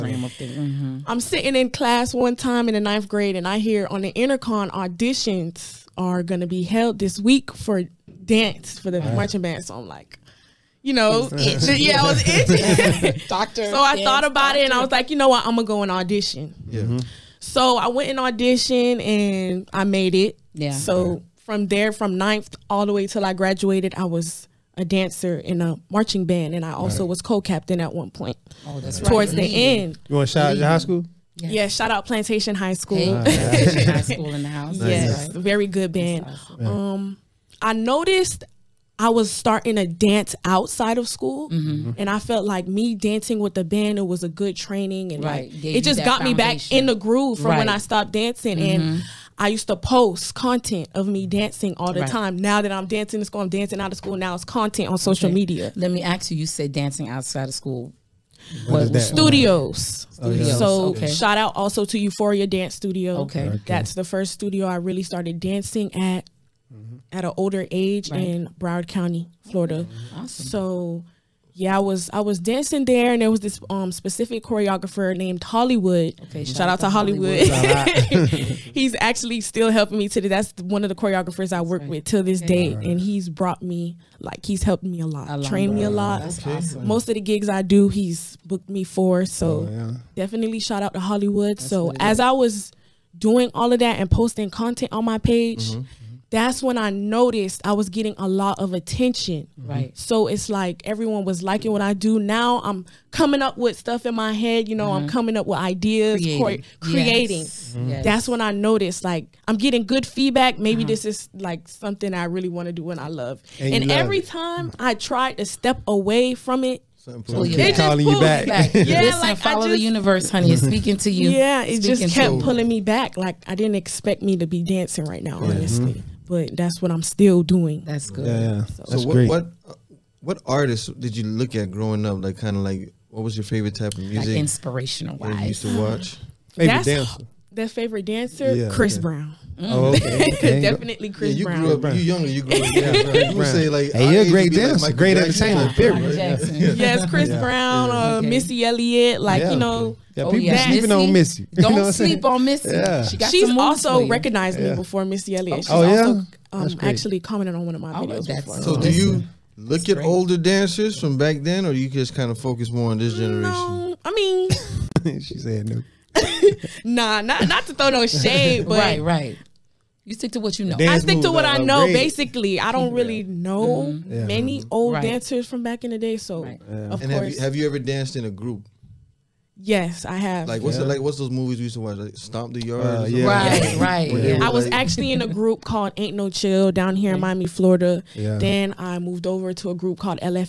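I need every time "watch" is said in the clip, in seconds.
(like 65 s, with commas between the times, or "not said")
135 s, 181 s.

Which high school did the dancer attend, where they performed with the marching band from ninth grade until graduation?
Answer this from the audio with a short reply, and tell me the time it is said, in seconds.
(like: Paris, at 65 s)
Plantation High School, at 32 s.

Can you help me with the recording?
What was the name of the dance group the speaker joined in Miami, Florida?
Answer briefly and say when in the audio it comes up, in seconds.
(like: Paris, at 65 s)
Ain't No Chill, at 185 s.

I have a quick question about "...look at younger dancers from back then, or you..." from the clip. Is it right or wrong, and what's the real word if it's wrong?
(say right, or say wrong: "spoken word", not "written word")
wrong: "older", not "younger".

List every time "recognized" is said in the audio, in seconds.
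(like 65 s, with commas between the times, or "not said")
154 s.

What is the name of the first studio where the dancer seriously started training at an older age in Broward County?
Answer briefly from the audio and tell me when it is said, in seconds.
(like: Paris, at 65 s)
Euphoria Dance Studio, at 61 s.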